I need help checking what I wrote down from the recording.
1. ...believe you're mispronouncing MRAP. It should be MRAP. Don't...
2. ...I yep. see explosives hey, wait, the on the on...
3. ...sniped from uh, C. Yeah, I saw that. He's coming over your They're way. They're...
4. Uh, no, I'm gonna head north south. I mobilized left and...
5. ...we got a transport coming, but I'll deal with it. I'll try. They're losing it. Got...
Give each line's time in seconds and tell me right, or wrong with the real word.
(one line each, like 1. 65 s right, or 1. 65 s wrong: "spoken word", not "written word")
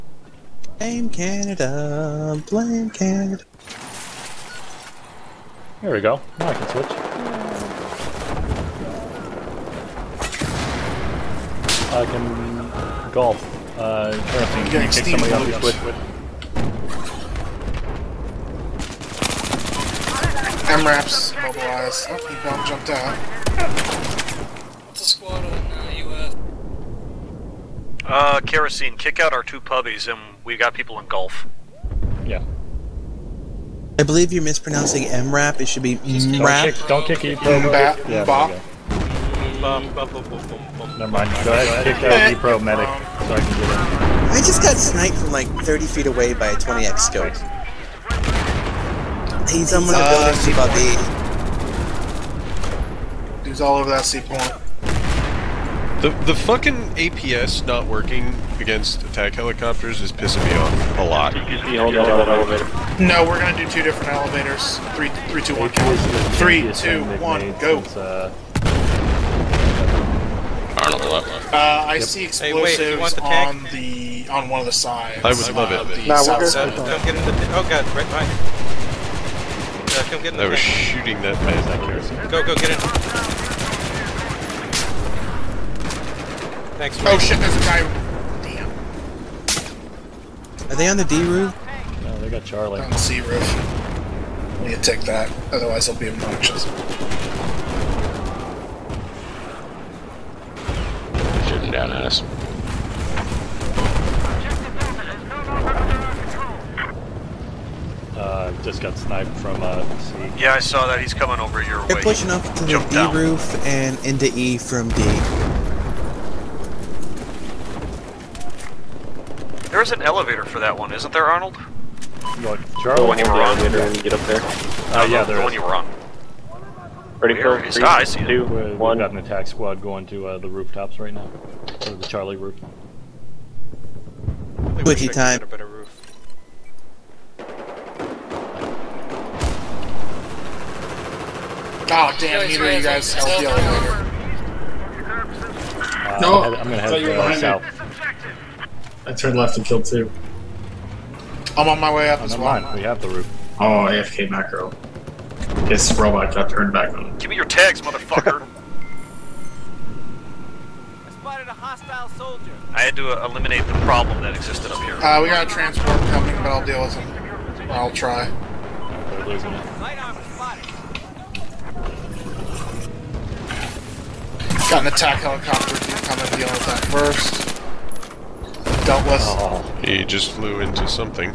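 1. 34 s right
2. 71 s right
3. 108 s right
4. 145 s wrong: "turned", not "mobilized"
5. 165 s right.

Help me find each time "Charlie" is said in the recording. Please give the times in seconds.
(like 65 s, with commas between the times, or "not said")
92 s, 122 s, 132 s.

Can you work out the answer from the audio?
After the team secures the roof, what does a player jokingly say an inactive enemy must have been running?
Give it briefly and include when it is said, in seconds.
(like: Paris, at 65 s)
AFK macro, at 153 s.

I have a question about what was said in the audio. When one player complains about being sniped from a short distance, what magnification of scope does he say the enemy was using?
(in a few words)
20x.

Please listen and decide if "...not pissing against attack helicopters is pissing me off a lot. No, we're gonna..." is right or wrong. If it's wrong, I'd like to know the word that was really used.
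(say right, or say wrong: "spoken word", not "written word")
wrong: "working", not "pissing".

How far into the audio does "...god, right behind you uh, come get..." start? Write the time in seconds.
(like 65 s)
77 s.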